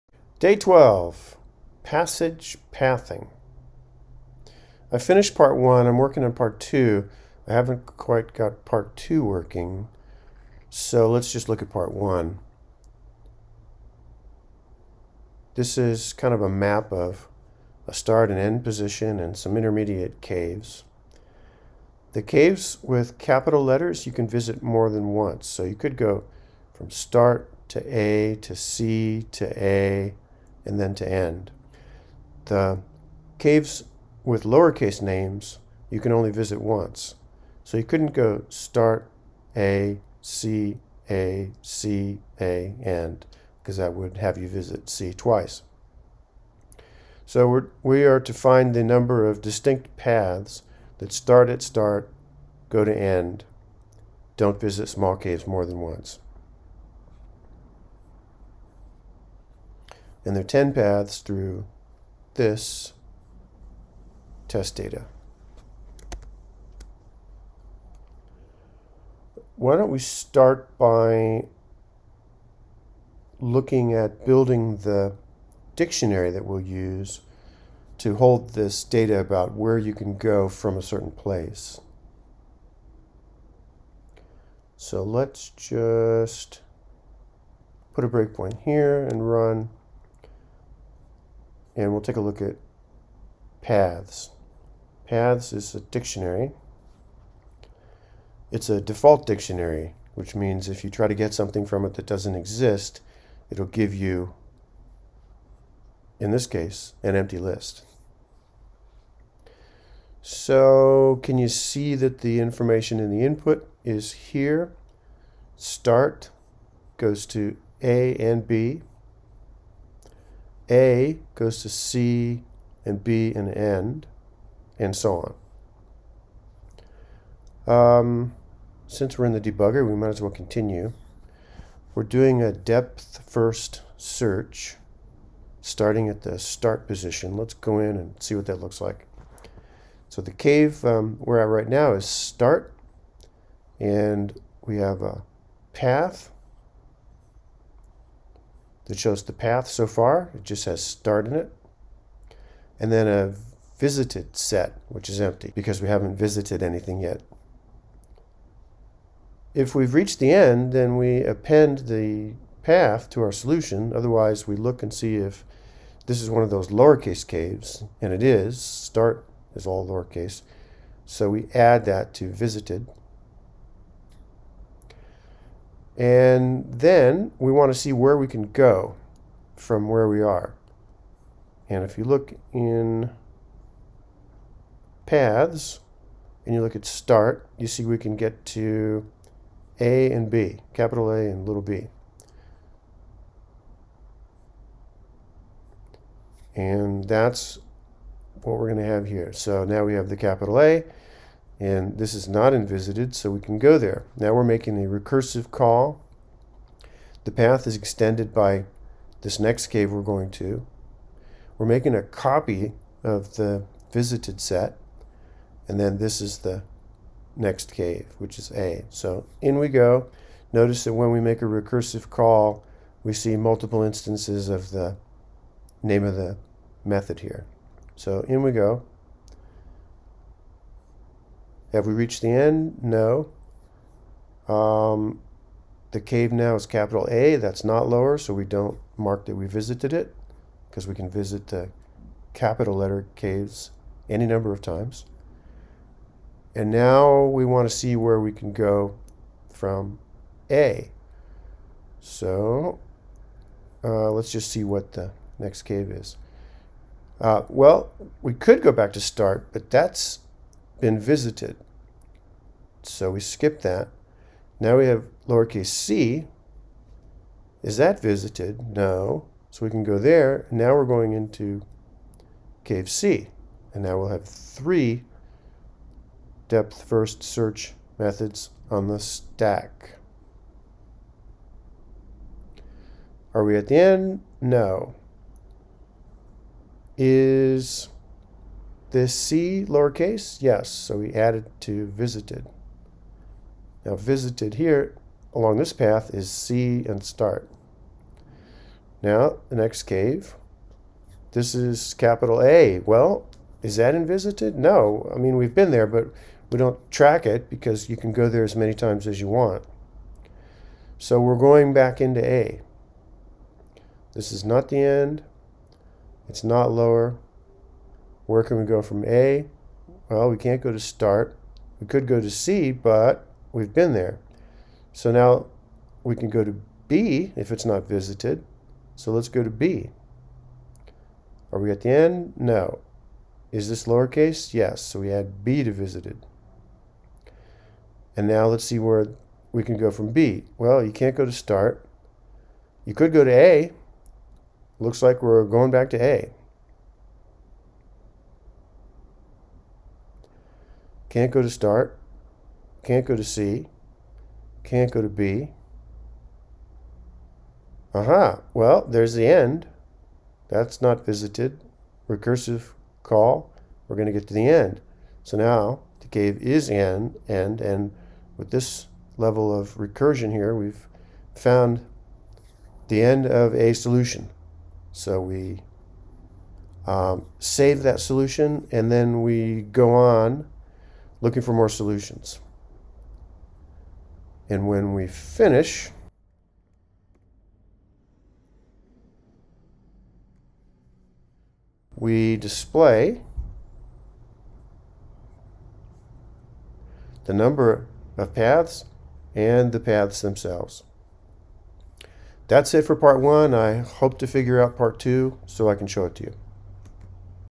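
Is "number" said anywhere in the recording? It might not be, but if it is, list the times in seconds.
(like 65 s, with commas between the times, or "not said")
48 s, 244 s, 397 s.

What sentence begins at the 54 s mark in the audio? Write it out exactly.
Don't visit small caves more than once.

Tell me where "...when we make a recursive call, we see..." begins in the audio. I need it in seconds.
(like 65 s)
220 s.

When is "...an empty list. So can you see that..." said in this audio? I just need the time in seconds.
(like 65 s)
107 s.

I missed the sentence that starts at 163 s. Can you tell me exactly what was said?
Otherwise, we look and see if this is one of those lowercase caves, and it is.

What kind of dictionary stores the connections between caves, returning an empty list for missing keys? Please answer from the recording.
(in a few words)
default dictionary.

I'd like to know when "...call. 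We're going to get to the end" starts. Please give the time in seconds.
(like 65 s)
363 s.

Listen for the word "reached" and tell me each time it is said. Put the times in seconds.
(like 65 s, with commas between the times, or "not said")
159 s, 231 s.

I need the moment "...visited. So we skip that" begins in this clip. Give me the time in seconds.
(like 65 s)
260 s.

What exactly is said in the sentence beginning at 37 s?
So you couldn't go start A, C, A, C, A, and, because that would have you visit C twice.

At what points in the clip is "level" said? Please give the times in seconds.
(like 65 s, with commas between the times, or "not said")
369 s.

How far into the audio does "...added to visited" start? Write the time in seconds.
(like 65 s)
291 s.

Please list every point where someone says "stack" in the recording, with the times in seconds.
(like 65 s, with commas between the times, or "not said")
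278 s.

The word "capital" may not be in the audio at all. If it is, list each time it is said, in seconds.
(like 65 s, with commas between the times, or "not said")
23 s, 190 s, 200 s, 236 s, 242 s, 301 s.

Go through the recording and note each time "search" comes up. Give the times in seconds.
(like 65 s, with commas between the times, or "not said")
133 s, 277 s.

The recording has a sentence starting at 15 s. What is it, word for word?
This is kind of a map of a start and end position and some intermediate caves.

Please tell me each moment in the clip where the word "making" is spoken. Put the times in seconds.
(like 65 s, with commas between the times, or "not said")
204 s, 211 s.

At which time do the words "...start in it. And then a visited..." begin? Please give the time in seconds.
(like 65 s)
150 s.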